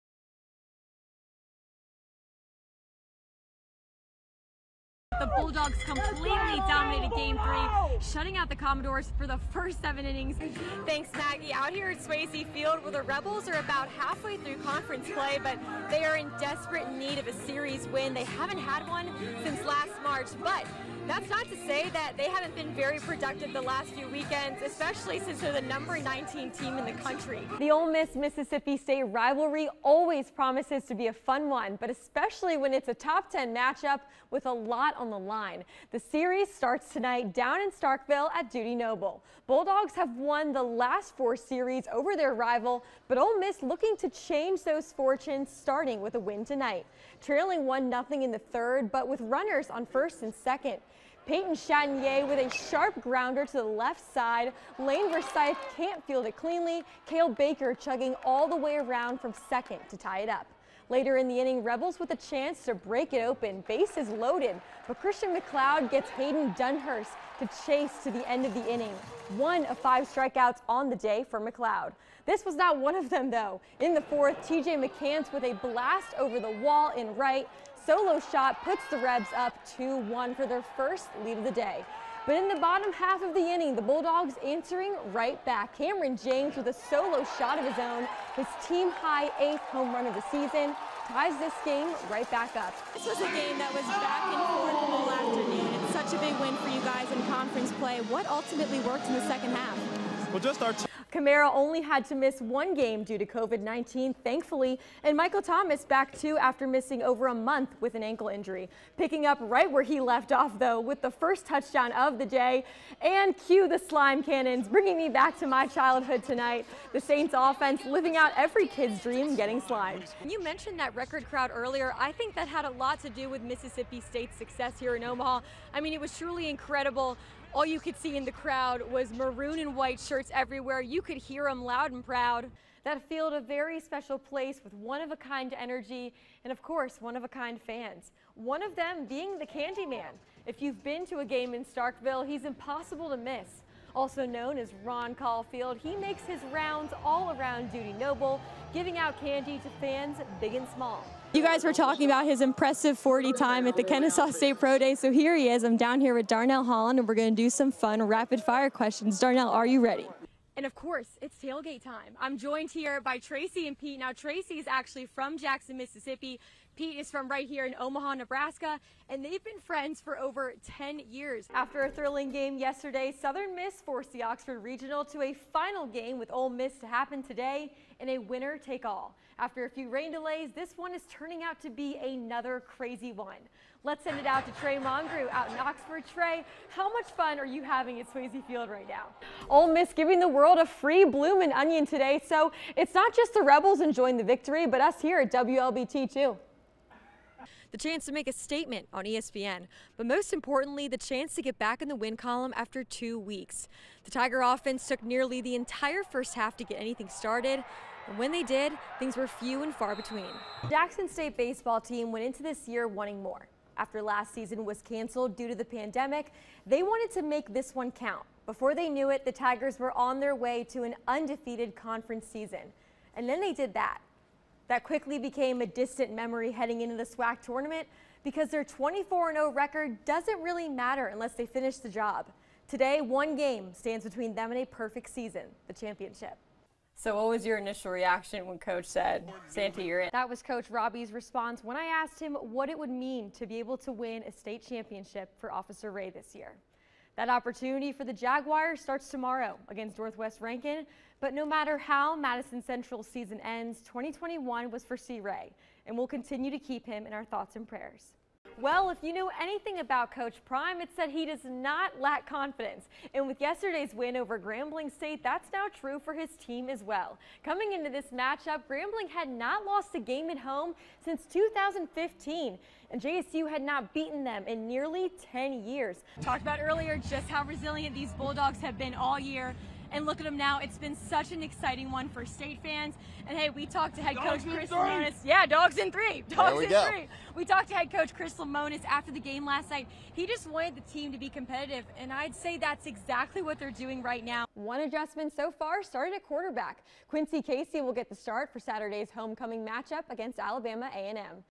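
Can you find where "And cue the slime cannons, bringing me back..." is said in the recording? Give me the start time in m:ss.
1:53.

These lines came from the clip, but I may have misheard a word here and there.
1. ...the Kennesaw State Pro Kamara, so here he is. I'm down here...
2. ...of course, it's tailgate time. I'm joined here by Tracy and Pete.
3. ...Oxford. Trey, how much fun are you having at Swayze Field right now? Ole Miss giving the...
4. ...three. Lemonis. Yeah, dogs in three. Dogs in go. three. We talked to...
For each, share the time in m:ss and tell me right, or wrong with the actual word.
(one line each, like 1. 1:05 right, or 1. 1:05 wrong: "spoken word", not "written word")
1. 2:33 wrong: "Day", not "Kamara"
2. 2:40 right
3. 3:05 right
4. 4:44 right.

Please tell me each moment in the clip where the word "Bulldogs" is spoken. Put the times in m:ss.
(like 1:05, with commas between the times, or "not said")
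0:05, 0:39, 1:23, 4:38.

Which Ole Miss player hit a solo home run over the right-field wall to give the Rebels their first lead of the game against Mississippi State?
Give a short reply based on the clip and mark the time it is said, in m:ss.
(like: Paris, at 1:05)
TJ McCants, at 1:14.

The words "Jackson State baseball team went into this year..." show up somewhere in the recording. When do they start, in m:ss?
3:30.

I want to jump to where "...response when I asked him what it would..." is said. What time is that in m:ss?
4:01.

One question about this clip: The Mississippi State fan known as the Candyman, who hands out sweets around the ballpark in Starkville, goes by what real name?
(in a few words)
Ron Caulfield.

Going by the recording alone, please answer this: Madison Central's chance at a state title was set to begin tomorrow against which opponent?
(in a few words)
Northwest Rankin.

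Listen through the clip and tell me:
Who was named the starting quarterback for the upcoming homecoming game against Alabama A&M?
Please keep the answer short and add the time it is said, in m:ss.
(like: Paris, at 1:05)
Quincy Casey, at 4:57.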